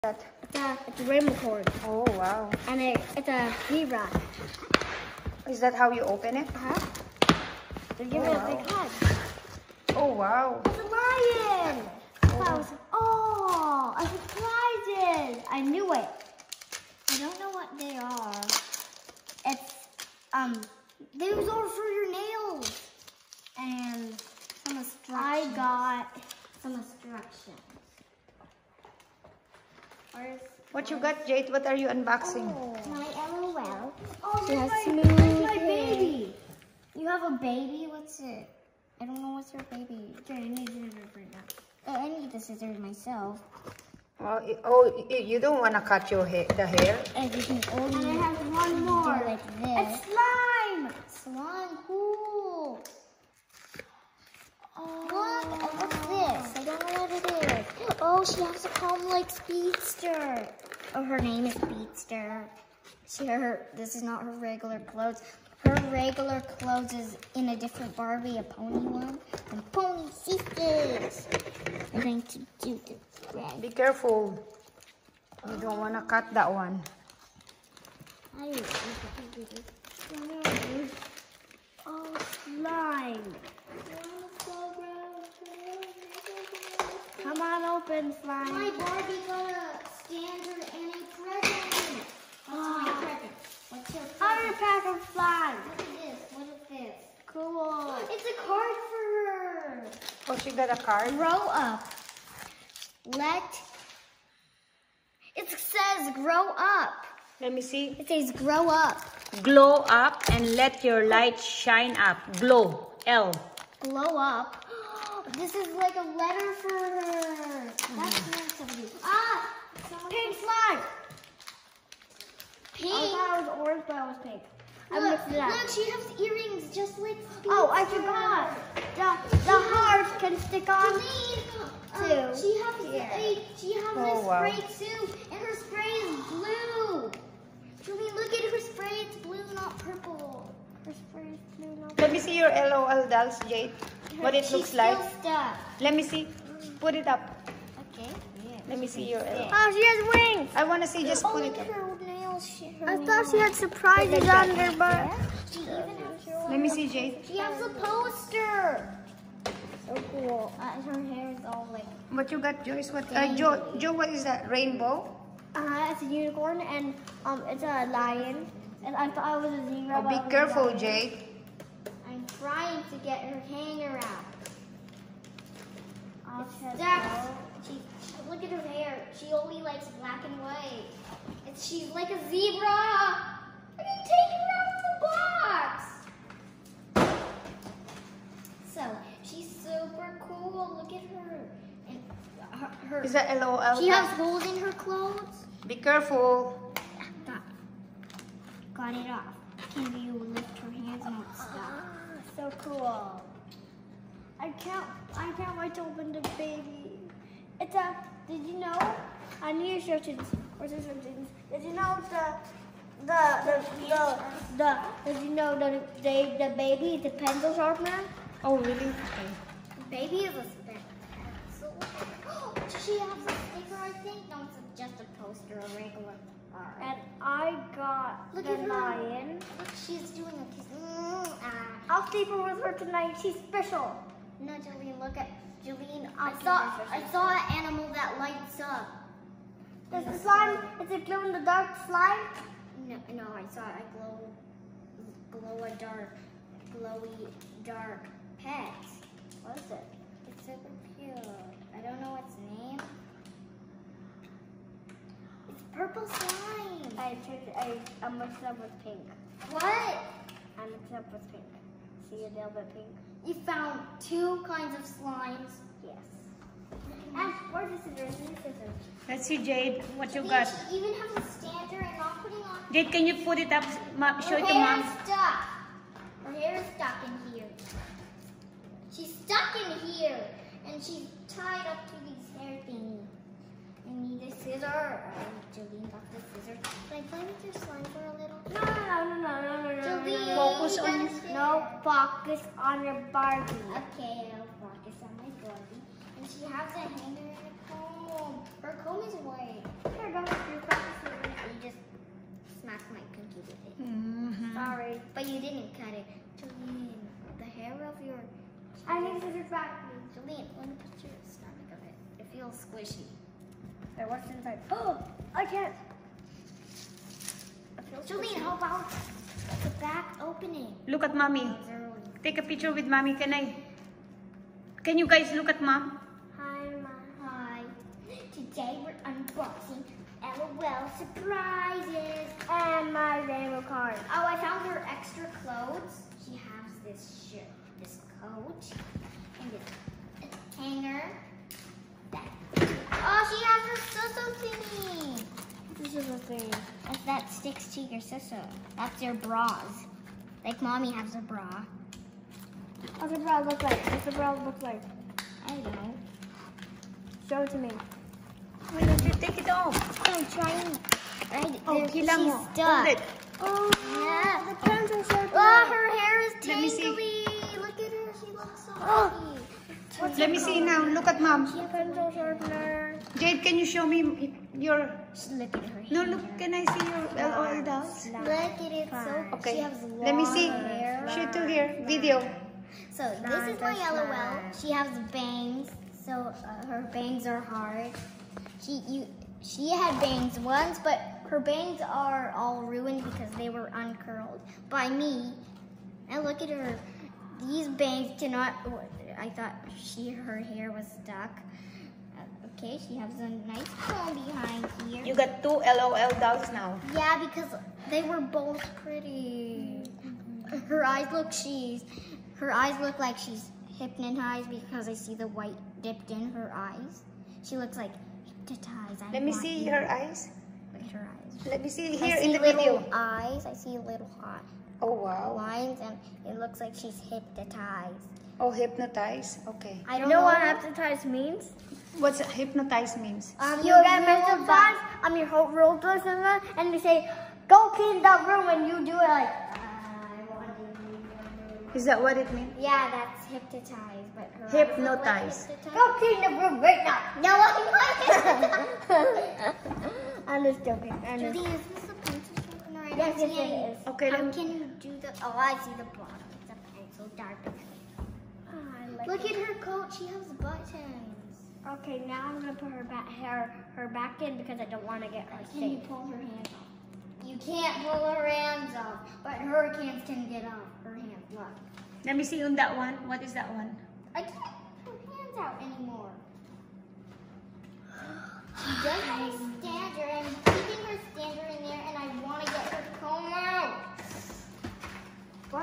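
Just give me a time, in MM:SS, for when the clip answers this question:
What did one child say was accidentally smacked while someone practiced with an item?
05:02.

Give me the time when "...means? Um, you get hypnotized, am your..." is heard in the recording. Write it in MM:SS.
07:12.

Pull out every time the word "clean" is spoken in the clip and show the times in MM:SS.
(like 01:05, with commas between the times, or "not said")
07:17, 07:25.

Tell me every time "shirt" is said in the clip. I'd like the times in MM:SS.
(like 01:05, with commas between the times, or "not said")
05:37.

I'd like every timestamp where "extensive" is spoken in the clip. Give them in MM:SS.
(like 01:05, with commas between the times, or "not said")
not said.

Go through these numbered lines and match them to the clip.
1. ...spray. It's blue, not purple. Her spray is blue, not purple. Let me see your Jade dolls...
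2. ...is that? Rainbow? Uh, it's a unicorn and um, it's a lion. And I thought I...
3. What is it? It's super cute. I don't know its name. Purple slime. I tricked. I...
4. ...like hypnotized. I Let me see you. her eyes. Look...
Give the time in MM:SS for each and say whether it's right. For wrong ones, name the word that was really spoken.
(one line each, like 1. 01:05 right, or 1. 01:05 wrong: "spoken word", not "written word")
1. 02:18 wrong: "LOL", not "Jade"
2. 02:44 right
3. 04:09 right
4. 06:57 right.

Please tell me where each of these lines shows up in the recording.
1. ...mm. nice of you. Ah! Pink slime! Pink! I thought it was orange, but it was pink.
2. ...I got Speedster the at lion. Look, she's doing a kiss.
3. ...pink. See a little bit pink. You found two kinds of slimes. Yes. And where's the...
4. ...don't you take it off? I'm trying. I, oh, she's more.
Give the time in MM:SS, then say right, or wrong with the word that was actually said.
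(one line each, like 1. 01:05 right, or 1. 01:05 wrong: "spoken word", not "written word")
1. 01:58 right
2. 03:47 wrong: "Look", not "Speedster"
3. 04:21 right
4. 05:58 right.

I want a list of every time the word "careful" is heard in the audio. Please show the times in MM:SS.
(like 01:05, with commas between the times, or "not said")
01:13, 02:50, 03:15.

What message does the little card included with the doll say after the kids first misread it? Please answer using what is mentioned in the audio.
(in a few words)
Glow up and let your light shine.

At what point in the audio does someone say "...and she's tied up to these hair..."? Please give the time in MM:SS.
04:40.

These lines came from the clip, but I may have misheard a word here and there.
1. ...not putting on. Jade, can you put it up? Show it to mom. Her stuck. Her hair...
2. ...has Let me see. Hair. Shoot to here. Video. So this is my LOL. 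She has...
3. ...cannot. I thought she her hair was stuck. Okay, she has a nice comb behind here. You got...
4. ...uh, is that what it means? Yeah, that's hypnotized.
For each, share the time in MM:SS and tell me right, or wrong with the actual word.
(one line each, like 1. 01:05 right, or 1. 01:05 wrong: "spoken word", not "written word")
1. 04:31 right
2. 06:19 right
3. 06:38 right
4. 07:19 right.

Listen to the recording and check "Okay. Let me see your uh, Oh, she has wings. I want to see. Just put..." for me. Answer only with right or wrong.
right.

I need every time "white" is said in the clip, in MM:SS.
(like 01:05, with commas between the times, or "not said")
03:00, 04:59, 06:55.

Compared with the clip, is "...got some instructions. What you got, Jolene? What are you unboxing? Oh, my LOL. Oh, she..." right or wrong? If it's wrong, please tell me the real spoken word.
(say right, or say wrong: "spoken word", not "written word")
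wrong: "Jade", not "Jolene".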